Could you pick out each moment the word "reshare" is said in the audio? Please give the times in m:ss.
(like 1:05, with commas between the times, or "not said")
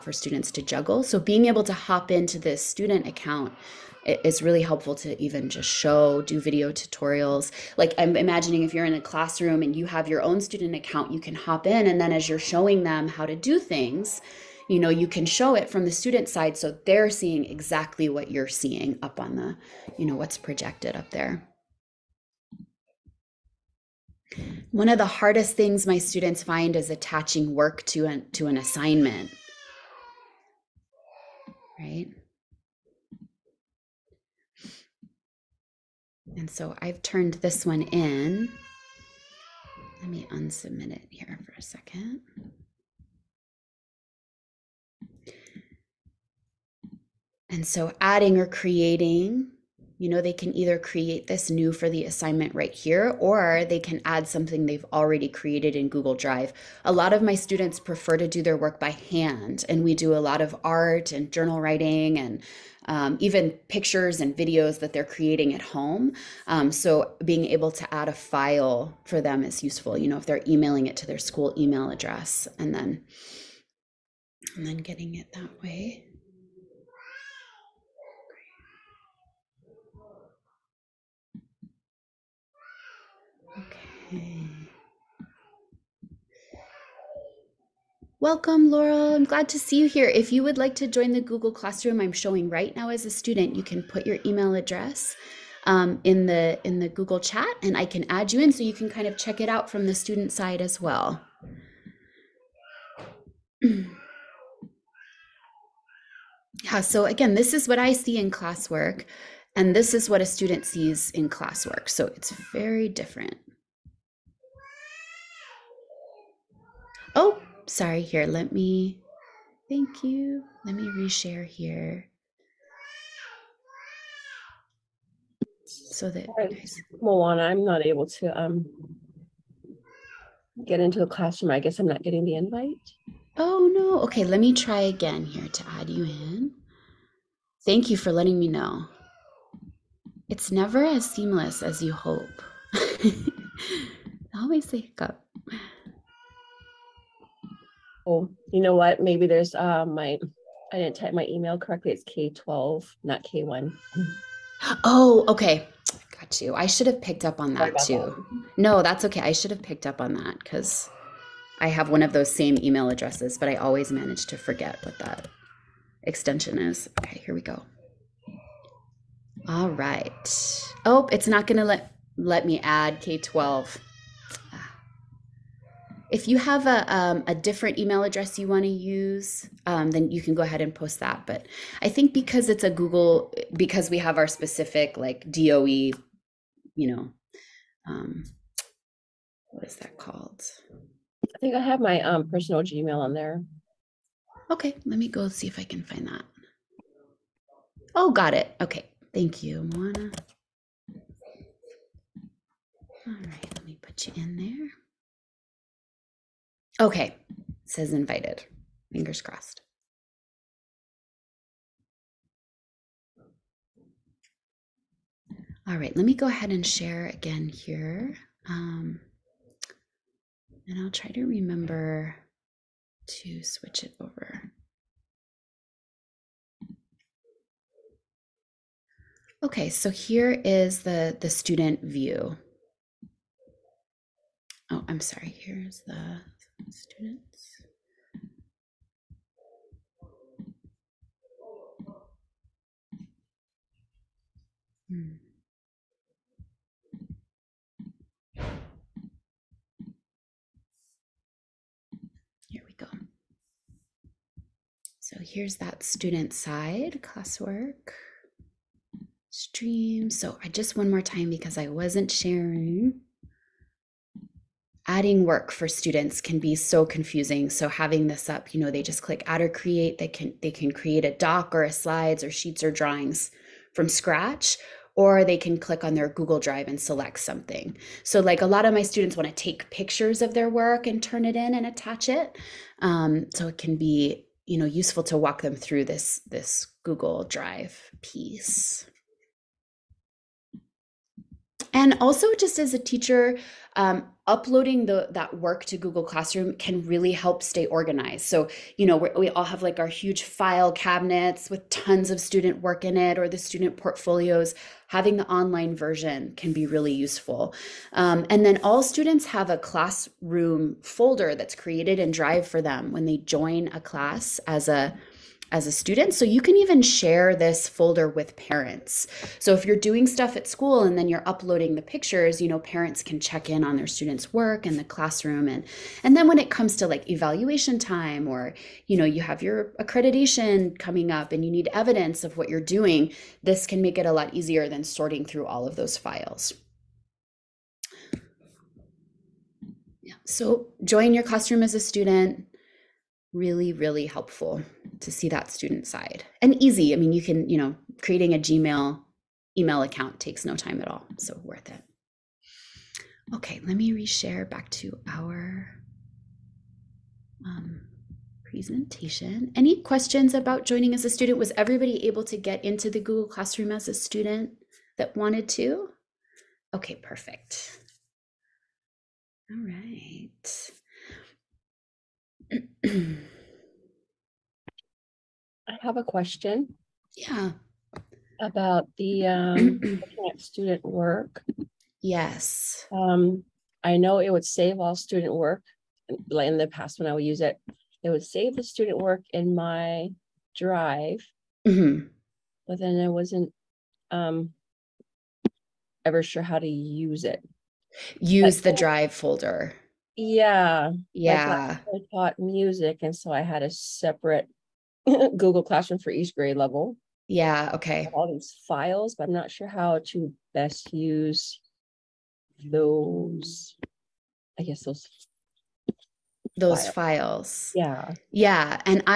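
2:00, 5:53.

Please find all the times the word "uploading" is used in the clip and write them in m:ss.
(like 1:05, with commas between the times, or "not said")
4:54, 5:21.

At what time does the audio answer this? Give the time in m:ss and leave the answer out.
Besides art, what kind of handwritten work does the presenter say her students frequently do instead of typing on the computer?
1:01.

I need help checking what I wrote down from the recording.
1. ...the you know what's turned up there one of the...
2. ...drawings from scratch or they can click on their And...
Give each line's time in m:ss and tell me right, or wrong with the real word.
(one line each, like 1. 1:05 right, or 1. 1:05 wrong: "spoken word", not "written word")
1. 0:19 wrong: "projected", not "turned"
2. 4:32 wrong: "Google", not "And".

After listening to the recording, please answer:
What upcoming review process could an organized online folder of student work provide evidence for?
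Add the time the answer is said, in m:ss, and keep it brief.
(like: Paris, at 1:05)
accreditation, at 5:29.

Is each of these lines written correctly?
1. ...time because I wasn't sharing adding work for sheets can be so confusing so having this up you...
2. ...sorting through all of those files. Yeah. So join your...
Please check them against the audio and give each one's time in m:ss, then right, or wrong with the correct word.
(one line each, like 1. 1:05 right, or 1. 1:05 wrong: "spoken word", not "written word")
1. 4:21 wrong: "students", not "sheets"
2. 5:34 right.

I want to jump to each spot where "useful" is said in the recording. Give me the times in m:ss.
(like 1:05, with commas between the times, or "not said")
1:09, 4:44, 5:06.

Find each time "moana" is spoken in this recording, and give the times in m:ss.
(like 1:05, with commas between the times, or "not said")
2:07, 3:19.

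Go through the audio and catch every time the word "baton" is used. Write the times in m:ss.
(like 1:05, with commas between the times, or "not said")
not said.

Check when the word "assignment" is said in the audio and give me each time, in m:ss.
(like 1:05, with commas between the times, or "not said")
0:28, 0:52.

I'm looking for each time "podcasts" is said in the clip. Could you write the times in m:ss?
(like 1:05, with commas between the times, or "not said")
not said.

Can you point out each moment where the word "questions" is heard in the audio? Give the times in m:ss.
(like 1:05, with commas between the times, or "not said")
5:59, 6:16.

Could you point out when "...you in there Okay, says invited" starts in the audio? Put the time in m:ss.
3:24.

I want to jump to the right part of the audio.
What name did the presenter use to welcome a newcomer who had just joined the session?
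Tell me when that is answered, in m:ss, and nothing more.
1:28.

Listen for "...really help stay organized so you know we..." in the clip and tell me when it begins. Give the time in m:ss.
4:56.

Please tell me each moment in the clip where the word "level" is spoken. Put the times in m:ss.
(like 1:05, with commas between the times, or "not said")
6:46.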